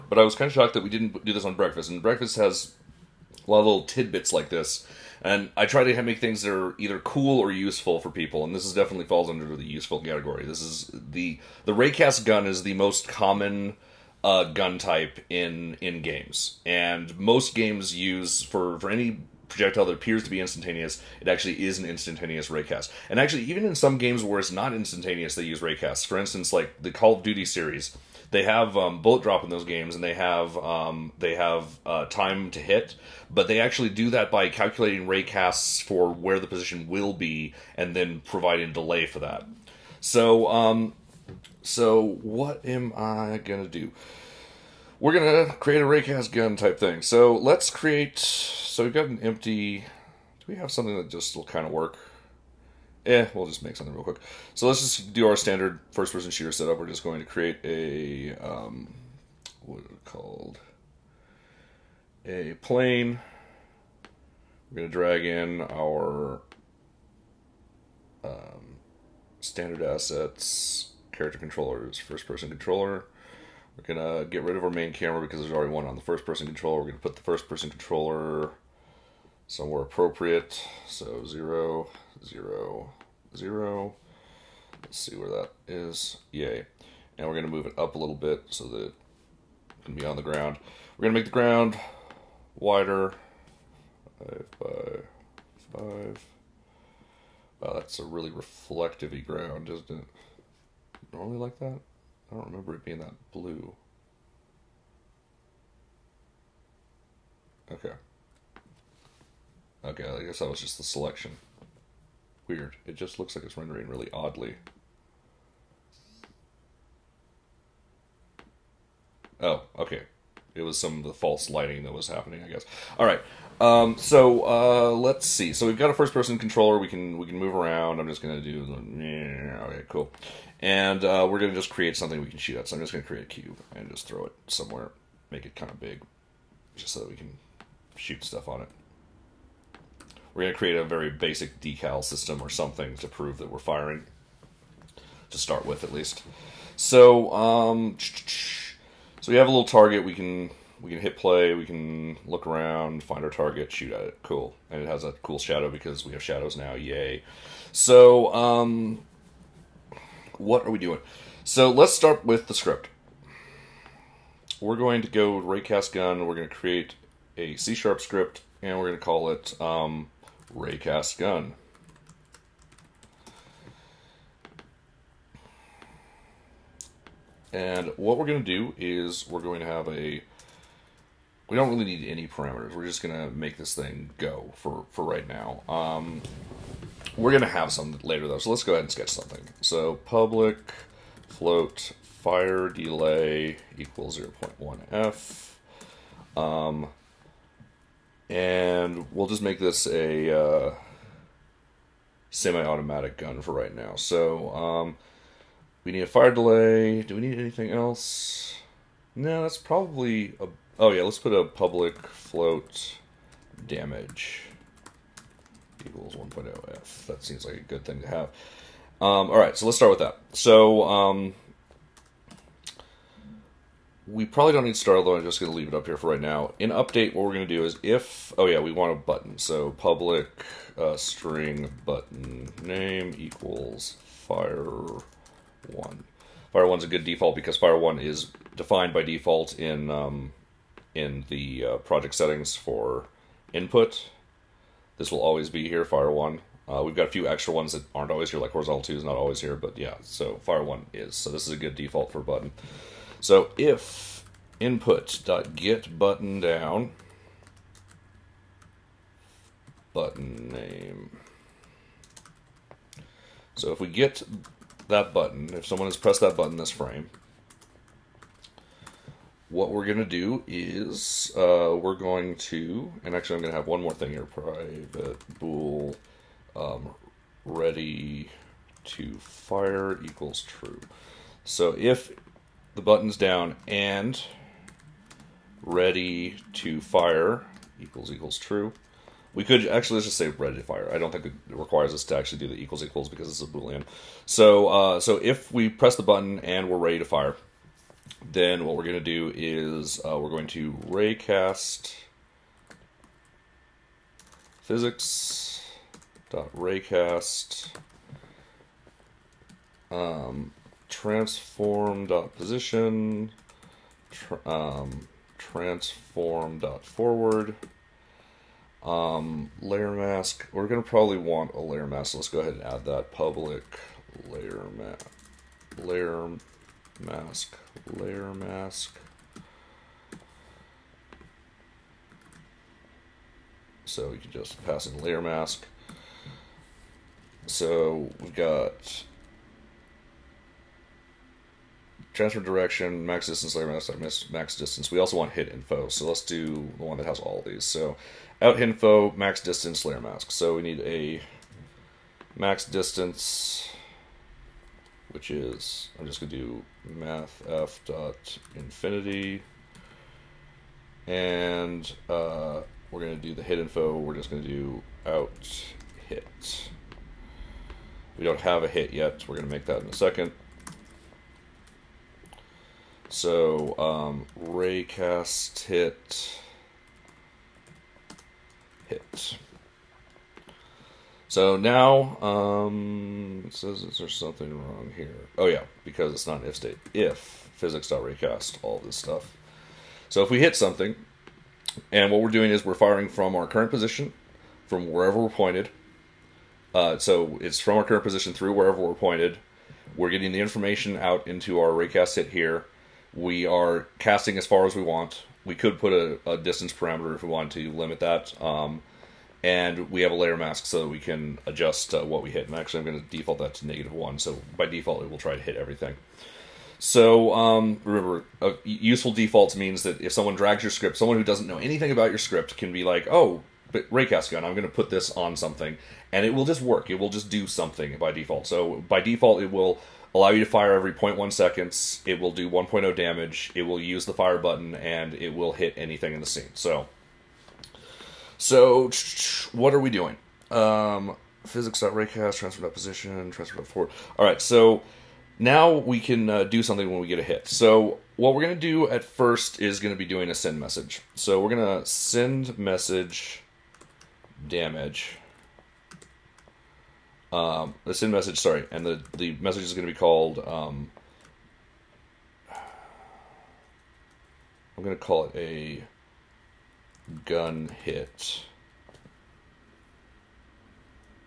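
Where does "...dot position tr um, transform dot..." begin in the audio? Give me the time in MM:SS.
05:12.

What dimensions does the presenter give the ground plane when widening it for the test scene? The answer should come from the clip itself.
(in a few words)
5 by 5.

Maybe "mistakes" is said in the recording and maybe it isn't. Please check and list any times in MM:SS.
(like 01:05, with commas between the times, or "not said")
not said.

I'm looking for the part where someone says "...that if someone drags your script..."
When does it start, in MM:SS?
06:59.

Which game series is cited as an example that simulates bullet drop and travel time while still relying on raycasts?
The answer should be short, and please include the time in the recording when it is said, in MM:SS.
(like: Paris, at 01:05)
Call of Duty, at 00:26.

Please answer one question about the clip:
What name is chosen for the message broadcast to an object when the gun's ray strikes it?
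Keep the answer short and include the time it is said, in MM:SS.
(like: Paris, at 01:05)
gun hit, at 07:47.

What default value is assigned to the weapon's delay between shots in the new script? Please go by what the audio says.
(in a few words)
0.1.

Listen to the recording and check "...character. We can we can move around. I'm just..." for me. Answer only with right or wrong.
wrong.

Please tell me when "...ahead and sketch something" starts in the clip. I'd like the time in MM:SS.
03:08.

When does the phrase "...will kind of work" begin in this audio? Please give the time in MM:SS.
00:51.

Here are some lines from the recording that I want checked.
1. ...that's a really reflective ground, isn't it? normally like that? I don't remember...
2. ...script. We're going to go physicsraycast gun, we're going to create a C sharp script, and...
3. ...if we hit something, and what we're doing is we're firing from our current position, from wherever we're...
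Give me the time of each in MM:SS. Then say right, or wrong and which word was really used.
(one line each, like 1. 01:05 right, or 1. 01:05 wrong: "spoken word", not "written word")
1. 01:37 right
2. 02:42 wrong: "raycast", not "physicsraycast"
3. 06:30 right.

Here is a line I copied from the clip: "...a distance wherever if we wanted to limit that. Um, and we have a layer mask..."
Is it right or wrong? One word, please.
wrong.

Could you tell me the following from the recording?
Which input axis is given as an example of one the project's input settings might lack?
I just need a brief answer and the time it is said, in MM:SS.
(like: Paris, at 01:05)
Horizontal 2, at 04:08.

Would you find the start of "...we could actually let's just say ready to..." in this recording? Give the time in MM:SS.
04:49.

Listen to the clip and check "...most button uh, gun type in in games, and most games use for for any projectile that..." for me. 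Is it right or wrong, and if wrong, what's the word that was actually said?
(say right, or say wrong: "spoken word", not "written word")
wrong: "common", not "button".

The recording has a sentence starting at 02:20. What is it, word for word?
We're gonna create a very basic decal system or something to prove that we're firing, to start with at least.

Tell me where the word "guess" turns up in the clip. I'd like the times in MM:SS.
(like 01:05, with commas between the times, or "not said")
01:50, 02:02.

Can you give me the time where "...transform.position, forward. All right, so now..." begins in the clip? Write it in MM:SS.
07:22.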